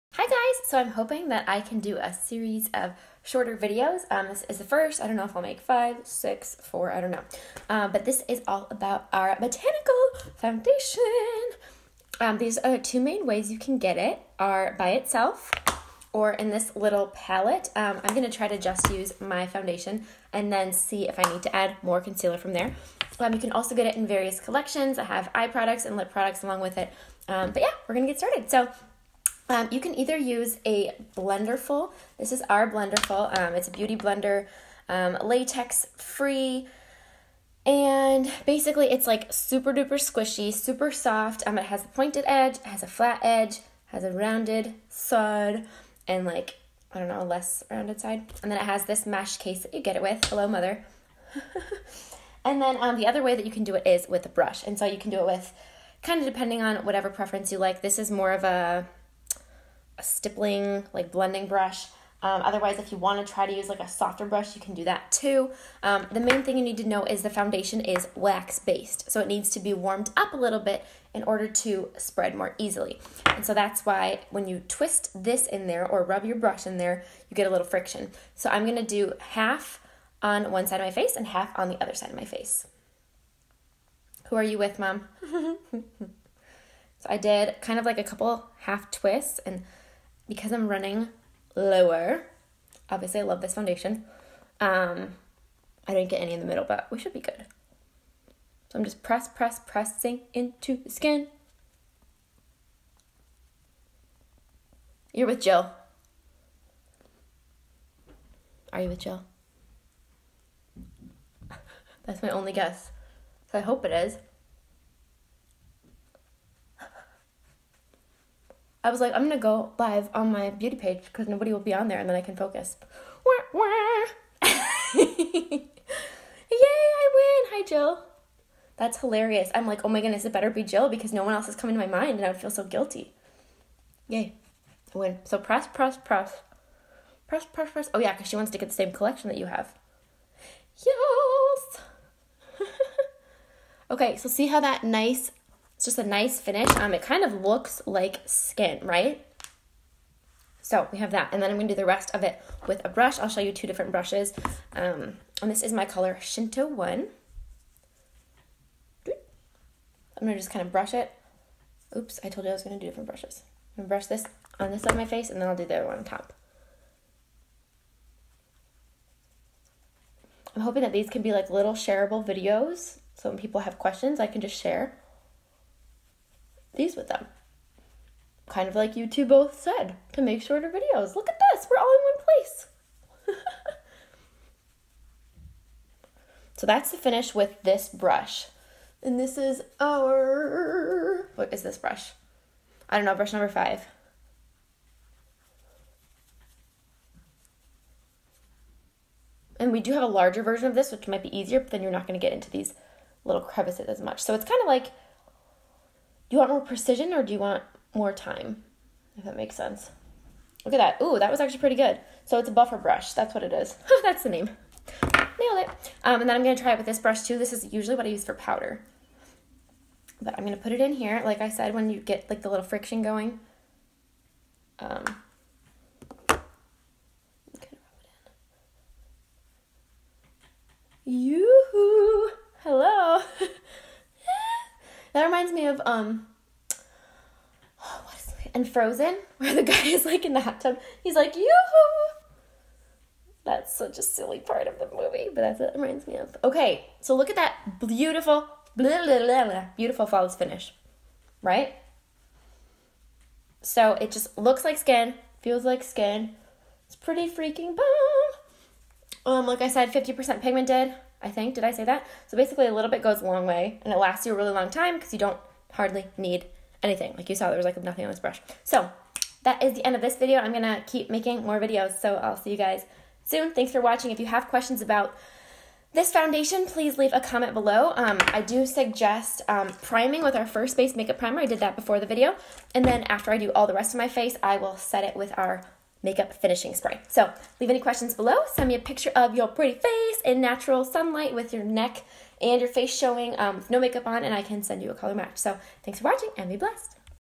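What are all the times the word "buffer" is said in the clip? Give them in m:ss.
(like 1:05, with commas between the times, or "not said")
3:32.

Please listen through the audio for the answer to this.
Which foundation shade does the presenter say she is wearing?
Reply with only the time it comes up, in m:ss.
2:36.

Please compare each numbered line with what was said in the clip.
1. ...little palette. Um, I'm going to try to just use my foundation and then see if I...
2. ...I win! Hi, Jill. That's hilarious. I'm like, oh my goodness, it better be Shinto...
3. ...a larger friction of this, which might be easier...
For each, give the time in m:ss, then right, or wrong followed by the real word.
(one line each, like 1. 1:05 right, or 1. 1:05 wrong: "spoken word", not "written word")
1. 0:16 right
2. 2:06 wrong: "Jill", not "Shinto"
3. 3:20 wrong: "version", not "friction".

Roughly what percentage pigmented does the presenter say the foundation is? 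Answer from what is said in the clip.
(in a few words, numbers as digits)
50%.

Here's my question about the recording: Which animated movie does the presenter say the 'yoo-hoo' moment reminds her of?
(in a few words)
Frozen.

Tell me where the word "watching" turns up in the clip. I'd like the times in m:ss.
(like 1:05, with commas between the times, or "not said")
4:33, 4:56.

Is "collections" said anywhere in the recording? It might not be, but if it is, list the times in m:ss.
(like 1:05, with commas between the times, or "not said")
0:24, 2:18.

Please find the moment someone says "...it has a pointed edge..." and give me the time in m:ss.
0:41.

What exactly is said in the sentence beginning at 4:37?
Um, I do suggest um, priming with our first base makeup primer.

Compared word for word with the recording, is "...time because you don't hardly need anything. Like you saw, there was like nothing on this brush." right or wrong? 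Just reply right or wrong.
right.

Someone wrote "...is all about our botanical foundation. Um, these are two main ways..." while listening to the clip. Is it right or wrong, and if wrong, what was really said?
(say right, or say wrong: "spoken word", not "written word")
right.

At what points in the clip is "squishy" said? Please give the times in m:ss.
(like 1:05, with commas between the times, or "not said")
0:39.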